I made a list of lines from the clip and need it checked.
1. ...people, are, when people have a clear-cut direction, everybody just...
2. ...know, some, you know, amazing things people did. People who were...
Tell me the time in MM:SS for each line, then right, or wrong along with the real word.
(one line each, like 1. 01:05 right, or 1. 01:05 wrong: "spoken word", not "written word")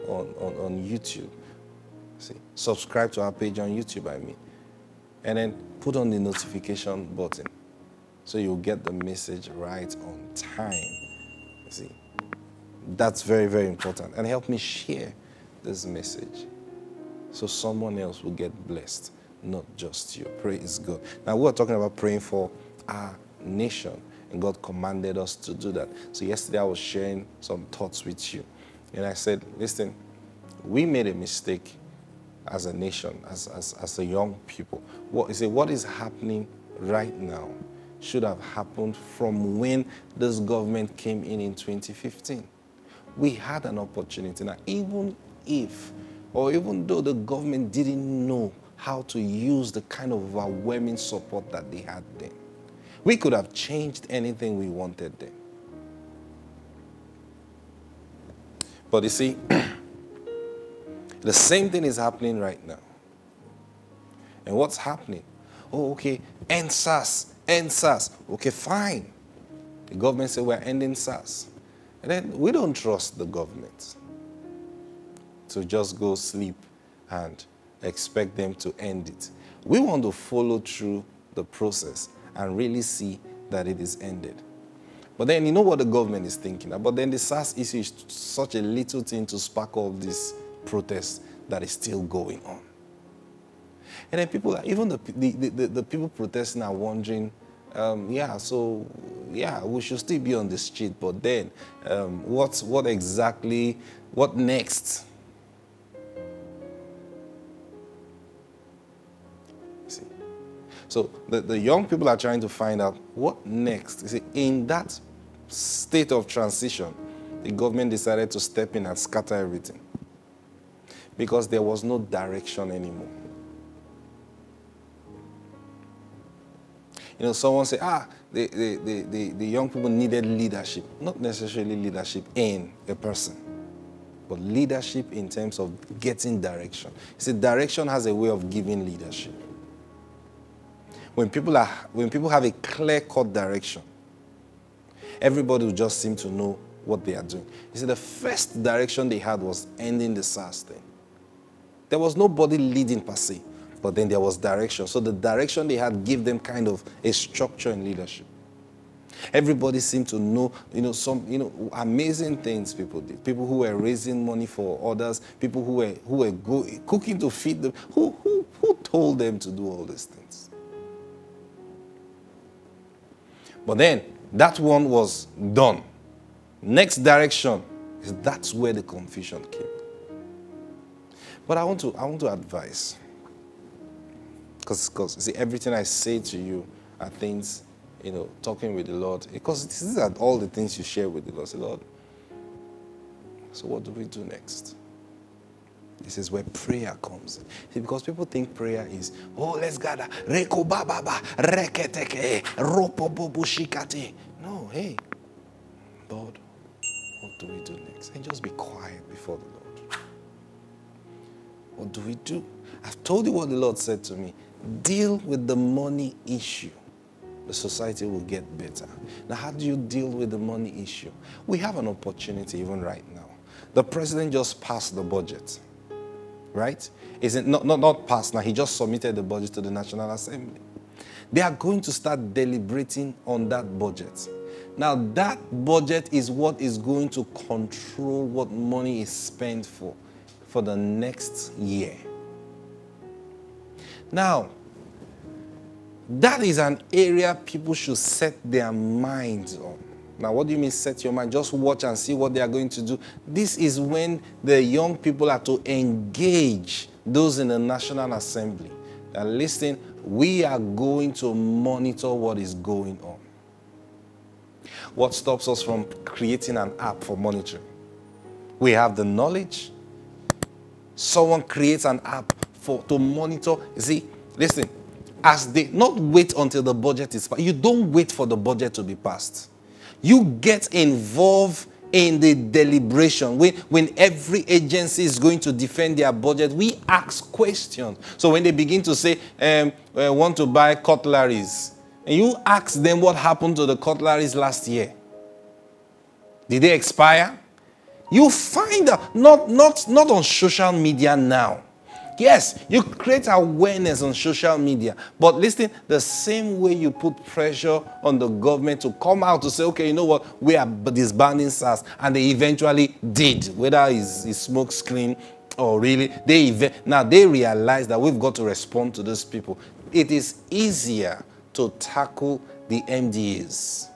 1. 02:21 right
2. 02:40 right.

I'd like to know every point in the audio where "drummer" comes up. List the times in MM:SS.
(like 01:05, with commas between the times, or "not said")
not said.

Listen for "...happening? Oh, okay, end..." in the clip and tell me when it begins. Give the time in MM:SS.
01:04.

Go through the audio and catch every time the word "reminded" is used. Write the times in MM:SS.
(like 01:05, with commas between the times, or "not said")
not said.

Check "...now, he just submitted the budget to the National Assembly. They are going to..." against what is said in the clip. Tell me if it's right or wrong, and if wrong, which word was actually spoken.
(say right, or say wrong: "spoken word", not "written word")
right.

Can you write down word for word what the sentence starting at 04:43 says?
When, when every agency is going to defend their budget, we ask questions.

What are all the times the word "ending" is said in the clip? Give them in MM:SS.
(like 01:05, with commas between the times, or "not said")
01:10, 02:29.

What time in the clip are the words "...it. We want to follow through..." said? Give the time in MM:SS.
01:19.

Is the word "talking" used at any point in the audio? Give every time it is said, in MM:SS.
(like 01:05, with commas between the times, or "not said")
00:21, 03:08.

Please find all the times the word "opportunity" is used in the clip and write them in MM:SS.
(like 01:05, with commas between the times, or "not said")
00:43, 03:41.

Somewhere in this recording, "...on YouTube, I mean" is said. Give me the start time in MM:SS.
00:03.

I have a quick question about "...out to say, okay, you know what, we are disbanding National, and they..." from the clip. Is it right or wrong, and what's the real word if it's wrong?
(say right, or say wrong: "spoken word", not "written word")
wrong: "SARS", not "National".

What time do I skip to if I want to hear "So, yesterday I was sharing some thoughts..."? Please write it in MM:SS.
00:26.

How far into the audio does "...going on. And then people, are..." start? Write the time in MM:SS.
01:32.